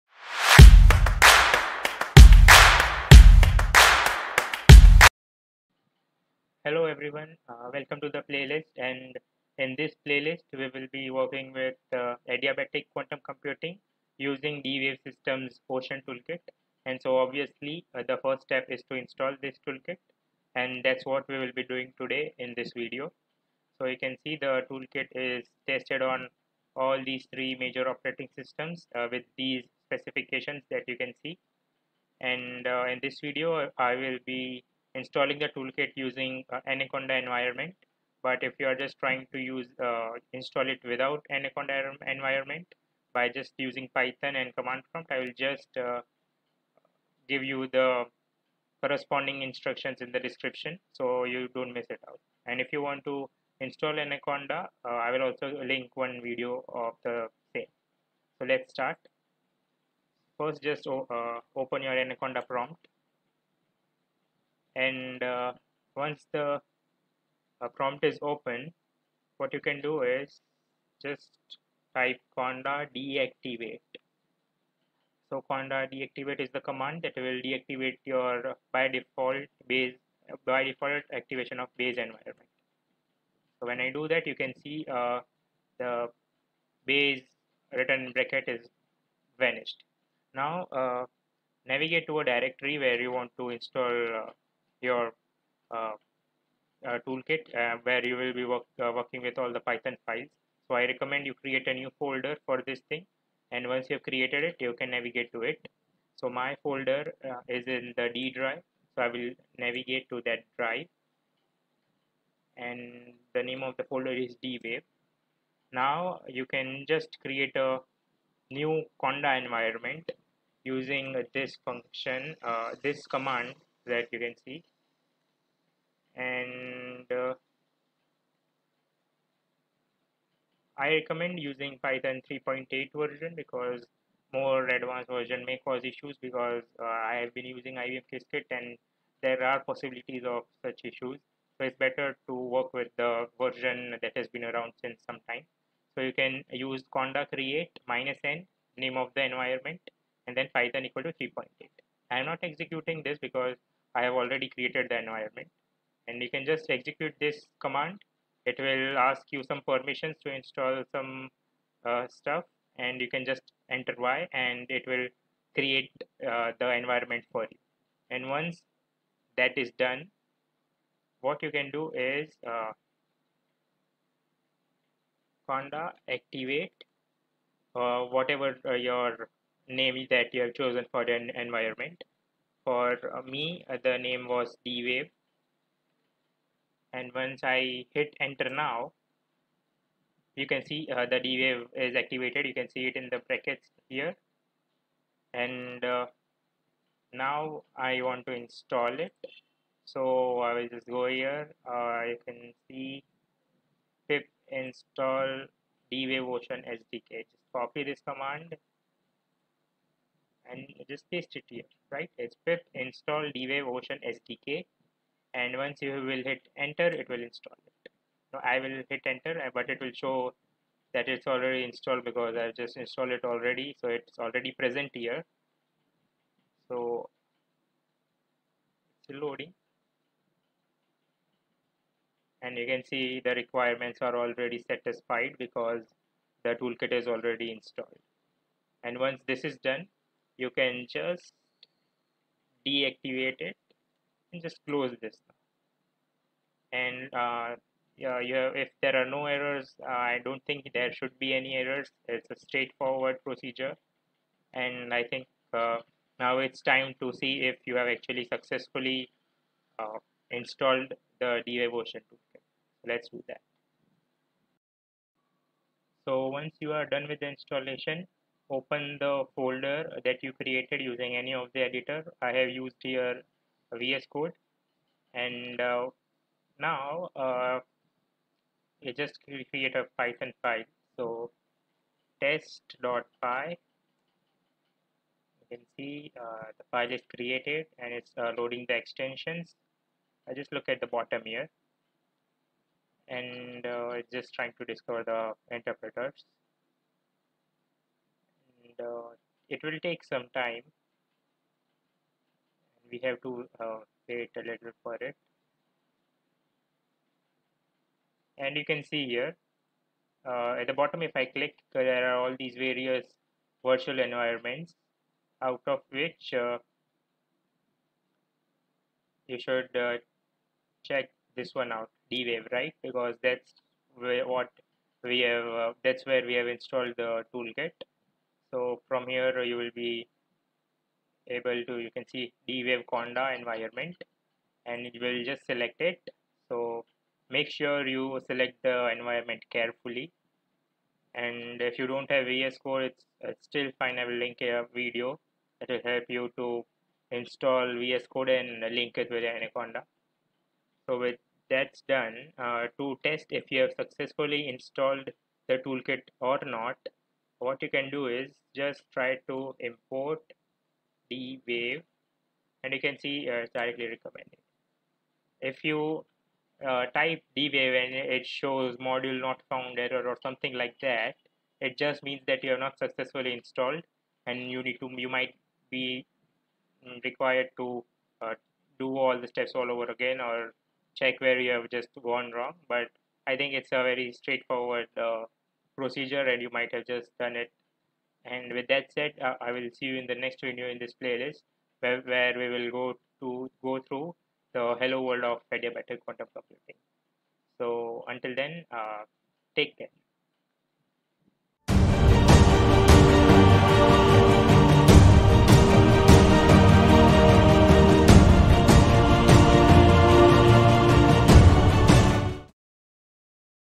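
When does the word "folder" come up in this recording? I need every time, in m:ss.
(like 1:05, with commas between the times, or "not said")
1:41, 1:46, 1:53, 4:29.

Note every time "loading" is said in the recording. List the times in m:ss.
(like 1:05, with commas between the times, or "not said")
3:49, 4:48.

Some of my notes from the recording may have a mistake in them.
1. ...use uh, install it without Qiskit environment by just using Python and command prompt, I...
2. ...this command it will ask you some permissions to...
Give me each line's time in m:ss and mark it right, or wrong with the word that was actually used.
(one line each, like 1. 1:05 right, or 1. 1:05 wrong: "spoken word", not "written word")
1. 0:39 wrong: "Anaconda", not "Qiskit"
2. 2:37 right.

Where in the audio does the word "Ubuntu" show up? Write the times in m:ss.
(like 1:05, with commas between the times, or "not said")
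not said.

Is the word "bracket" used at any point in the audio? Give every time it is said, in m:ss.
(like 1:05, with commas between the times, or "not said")
1:28, 3:13.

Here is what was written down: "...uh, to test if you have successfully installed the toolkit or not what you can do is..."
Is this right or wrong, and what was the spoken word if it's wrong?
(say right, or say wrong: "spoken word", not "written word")
right.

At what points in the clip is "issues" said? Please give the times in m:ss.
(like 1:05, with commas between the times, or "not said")
2:15, 2:20.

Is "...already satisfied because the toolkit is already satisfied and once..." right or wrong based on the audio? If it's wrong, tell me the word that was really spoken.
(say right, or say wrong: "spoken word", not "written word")
wrong: "installed", not "satisfied".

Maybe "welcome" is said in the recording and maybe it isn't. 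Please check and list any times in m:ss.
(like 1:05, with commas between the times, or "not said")
0:07.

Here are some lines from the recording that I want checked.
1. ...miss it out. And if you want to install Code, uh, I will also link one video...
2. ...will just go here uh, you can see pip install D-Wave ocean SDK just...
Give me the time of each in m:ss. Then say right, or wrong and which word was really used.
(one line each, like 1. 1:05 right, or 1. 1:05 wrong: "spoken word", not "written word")
1. 0:51 wrong: "Anaconda", not "Code"
2. 3:20 right.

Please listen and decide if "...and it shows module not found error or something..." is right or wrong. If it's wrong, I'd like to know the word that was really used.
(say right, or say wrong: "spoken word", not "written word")
right.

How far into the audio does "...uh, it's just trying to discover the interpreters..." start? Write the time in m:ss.
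4:53.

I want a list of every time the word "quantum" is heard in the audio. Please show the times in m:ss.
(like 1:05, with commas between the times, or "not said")
0:12, 6:36.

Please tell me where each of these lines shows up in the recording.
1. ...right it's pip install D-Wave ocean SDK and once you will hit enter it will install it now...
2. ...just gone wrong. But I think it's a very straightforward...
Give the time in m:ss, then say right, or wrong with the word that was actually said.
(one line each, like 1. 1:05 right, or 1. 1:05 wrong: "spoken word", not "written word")
1. 3:31 right
2. 6:21 right.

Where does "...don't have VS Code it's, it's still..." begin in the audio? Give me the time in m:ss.
5:41.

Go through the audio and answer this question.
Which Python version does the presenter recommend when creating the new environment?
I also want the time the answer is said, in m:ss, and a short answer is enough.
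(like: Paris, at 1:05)
3.8, at 2:11.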